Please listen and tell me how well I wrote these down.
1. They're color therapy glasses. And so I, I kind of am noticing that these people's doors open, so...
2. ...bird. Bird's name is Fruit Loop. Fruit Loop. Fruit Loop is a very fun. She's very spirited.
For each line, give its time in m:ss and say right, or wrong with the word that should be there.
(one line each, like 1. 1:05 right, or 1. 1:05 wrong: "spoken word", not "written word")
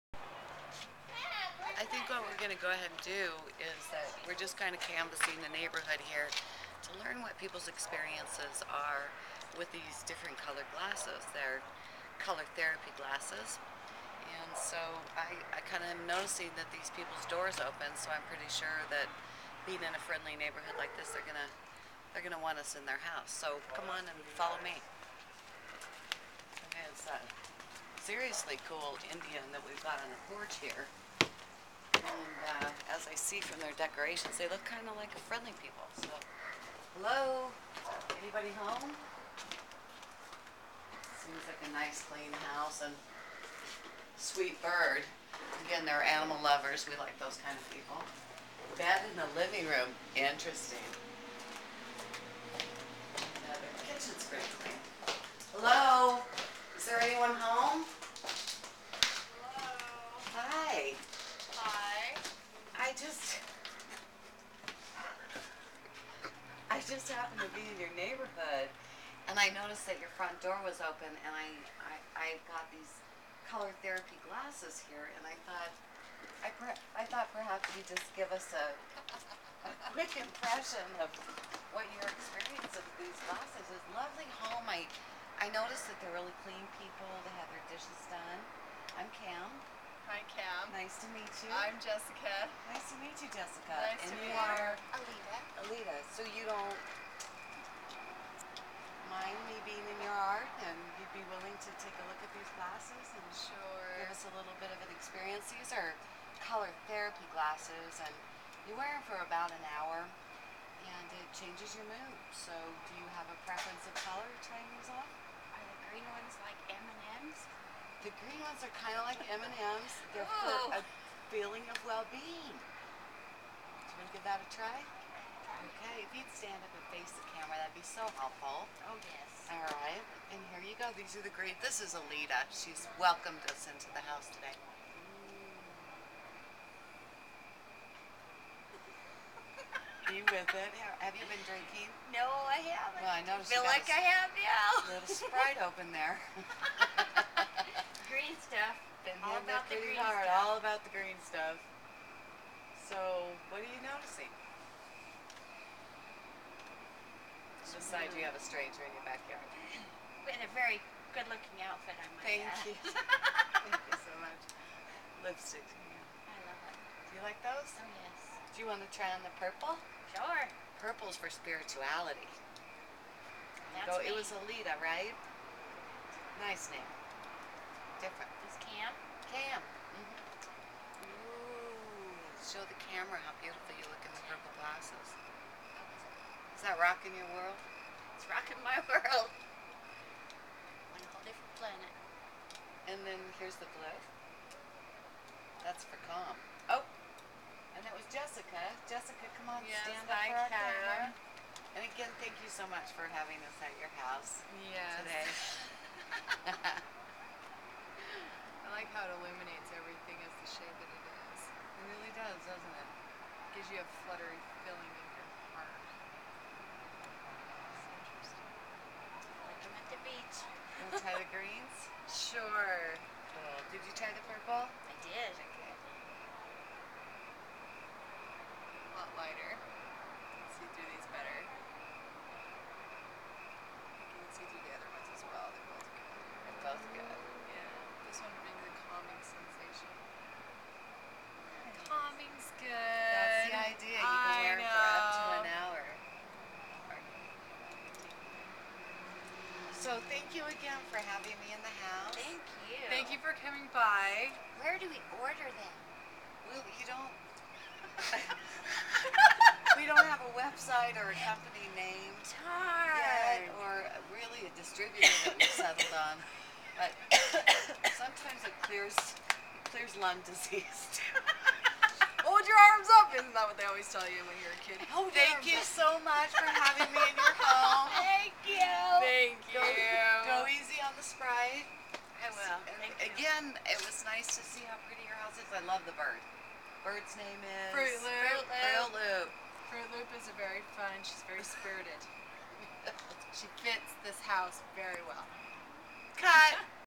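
1. 0:11 right
2. 4:45 right.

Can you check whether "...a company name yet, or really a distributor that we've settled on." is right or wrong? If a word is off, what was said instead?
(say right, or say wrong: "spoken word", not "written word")
right.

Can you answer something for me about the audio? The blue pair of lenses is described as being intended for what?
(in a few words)
calm.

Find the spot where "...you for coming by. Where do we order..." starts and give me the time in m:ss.
4:13.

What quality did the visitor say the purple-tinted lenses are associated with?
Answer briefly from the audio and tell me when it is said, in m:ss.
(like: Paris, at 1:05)
spirituality, at 2:50.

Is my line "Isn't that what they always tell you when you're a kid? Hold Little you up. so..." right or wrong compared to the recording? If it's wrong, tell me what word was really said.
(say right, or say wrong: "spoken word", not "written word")
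wrong: "Thank", not "Little".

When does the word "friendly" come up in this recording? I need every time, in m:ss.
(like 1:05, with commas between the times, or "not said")
0:20, 0:35.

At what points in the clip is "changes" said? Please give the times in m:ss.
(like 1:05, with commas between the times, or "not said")
1:51.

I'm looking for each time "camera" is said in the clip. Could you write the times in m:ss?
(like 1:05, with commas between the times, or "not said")
2:07, 3:02.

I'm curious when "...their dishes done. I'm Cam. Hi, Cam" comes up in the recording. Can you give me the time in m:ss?
1:27.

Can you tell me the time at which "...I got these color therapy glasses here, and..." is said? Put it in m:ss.
1:12.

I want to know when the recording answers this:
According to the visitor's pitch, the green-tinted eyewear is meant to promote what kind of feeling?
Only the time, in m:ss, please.
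2:00.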